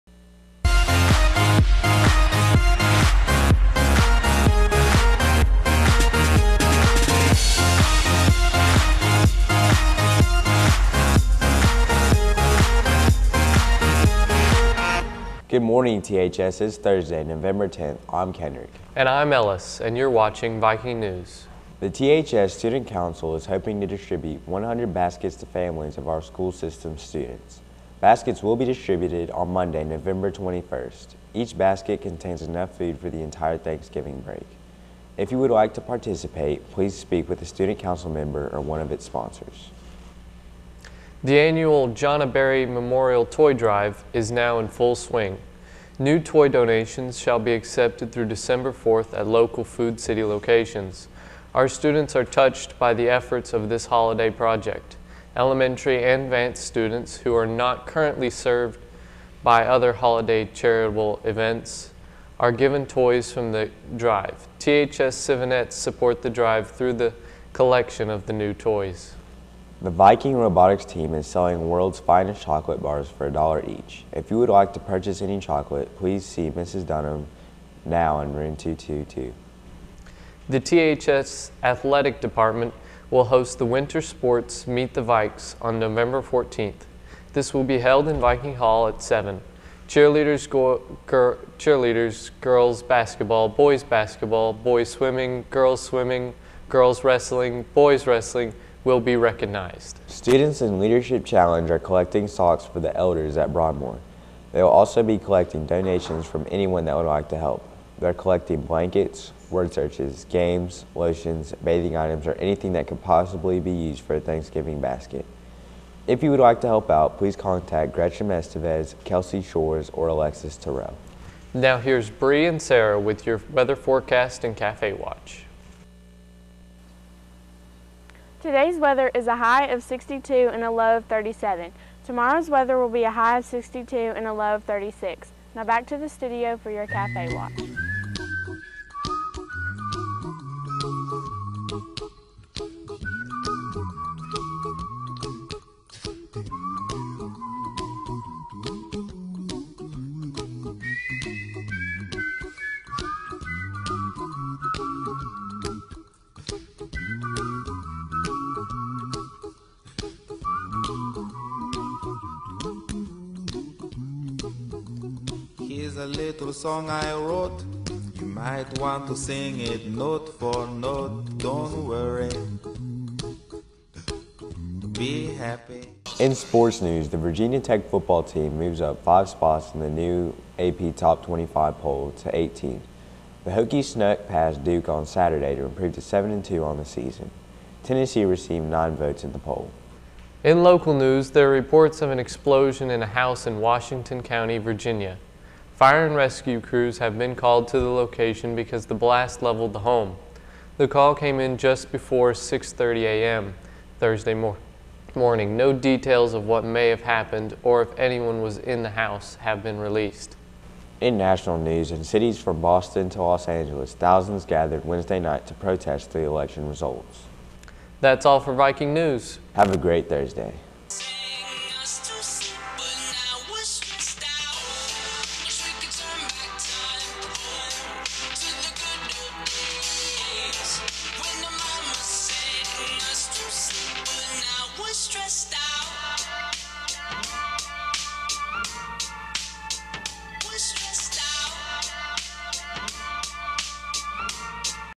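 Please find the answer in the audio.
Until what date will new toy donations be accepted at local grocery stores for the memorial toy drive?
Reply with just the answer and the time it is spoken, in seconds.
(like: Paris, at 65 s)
December 4th, at 48 s.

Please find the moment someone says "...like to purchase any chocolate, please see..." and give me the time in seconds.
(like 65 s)
74 s.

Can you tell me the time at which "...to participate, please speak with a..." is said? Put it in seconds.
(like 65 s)
35 s.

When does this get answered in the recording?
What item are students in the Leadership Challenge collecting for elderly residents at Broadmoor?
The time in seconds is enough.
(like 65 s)
102 s.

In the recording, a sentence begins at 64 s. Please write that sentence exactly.
THS Civinettes support the drive through the collection of the new toys.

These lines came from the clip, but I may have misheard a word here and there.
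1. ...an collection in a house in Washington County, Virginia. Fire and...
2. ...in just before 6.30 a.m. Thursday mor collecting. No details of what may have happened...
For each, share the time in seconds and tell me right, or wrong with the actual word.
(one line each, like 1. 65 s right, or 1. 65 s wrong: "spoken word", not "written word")
1. 192 s wrong: "explosion", not "collection"
2. 201 s wrong: "morning", not "collecting".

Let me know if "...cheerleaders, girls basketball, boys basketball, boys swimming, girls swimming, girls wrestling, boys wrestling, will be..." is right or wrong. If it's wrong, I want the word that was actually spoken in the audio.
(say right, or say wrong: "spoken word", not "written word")
right.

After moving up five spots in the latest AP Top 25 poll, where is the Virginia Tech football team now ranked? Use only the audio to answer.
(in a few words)
18.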